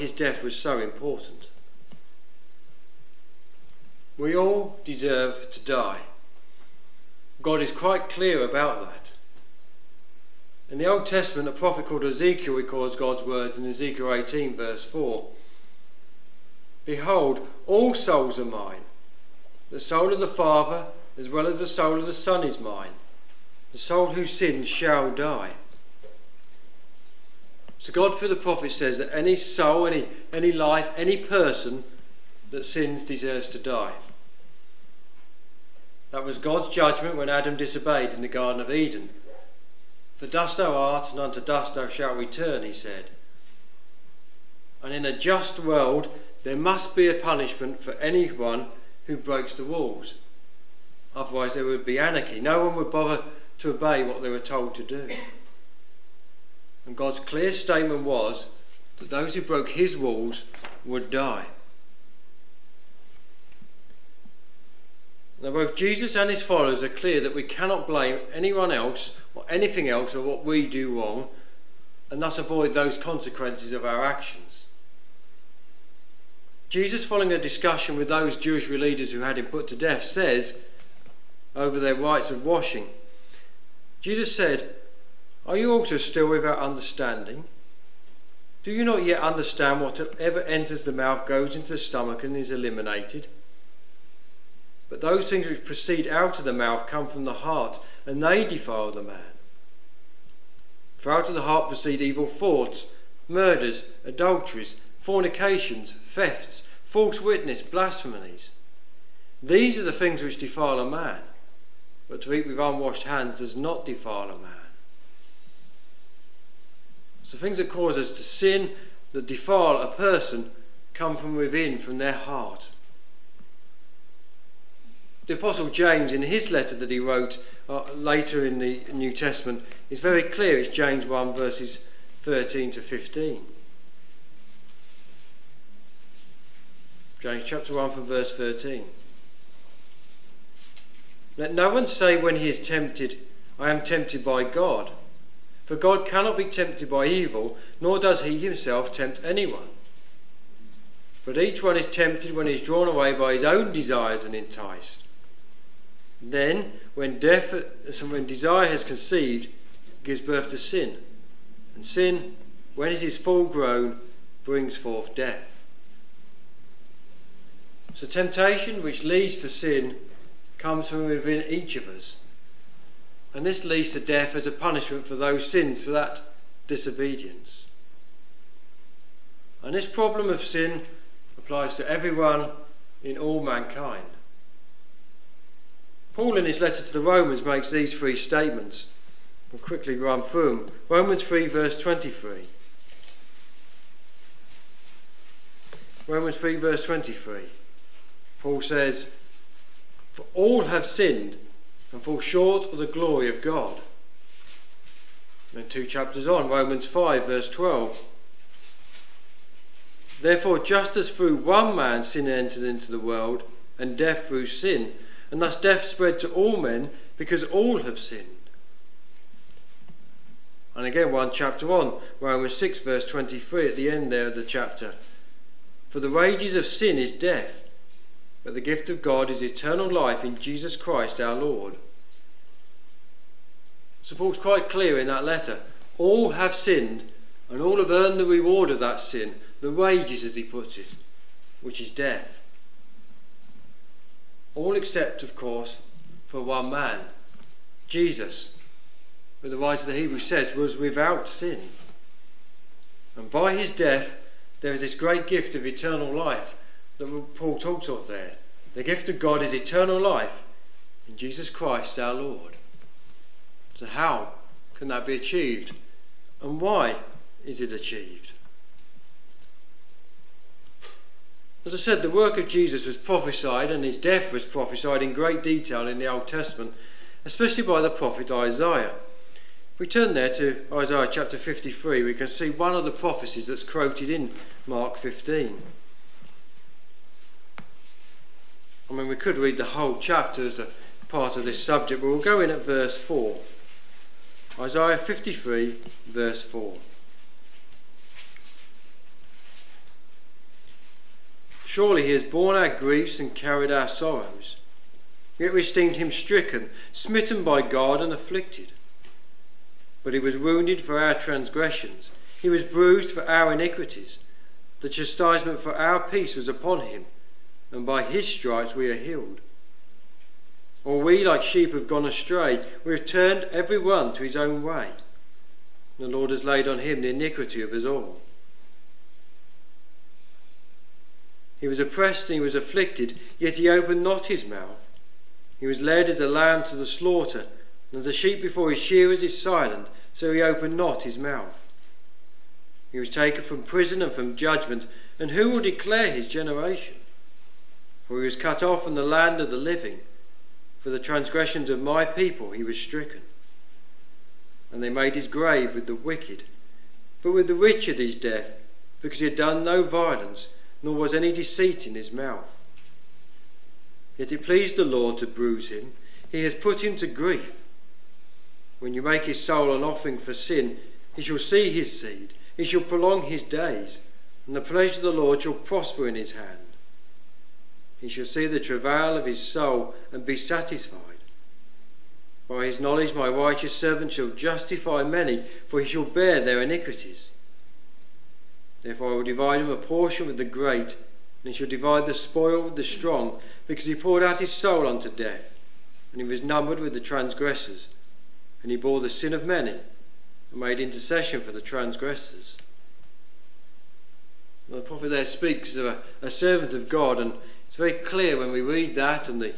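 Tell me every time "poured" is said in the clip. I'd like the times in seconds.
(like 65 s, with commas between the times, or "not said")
393 s.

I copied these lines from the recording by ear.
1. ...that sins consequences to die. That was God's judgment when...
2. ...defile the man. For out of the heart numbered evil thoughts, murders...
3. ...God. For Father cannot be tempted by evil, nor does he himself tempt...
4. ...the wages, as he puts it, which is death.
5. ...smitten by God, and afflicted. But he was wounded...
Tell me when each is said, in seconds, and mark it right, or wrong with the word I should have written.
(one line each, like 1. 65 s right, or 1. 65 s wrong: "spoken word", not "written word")
1. 32 s wrong: "deserves", not "consequences"
2. 98 s wrong: "proceed", not "numbered"
3. 144 s wrong: "God", not "Father"
4. 239 s right
5. 306 s right.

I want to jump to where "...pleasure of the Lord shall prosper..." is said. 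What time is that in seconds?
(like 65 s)
374 s.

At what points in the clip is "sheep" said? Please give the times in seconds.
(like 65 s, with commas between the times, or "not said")
321 s, 338 s.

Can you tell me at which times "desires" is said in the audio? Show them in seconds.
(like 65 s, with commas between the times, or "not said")
153 s, 158 s.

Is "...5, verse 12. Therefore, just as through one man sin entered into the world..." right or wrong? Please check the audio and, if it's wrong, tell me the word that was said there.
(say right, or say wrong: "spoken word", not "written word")
right.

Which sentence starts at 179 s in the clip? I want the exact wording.
And this problem of sin applies to everyone in all mankind.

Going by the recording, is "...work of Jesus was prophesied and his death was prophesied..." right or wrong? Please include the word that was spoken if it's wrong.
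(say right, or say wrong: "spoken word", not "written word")
right.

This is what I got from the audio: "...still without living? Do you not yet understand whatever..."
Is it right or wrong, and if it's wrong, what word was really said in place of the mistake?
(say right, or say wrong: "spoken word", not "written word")
wrong: "understanding", not "living".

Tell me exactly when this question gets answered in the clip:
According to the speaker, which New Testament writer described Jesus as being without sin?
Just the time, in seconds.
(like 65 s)
249 s.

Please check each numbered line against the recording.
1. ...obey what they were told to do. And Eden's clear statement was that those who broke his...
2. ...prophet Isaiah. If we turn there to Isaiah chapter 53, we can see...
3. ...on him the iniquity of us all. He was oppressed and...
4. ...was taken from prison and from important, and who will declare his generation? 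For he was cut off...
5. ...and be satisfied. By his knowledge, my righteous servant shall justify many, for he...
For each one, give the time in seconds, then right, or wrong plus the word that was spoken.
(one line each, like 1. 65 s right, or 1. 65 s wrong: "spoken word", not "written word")
1. 53 s wrong: "God", not "Eden"
2. 277 s right
3. 326 s right
4. 342 s wrong: "judgment", not "important"
5. 380 s right.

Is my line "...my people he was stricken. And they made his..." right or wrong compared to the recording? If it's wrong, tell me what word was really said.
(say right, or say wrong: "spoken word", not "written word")
right.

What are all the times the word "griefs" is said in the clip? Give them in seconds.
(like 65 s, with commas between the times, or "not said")
302 s, 367 s.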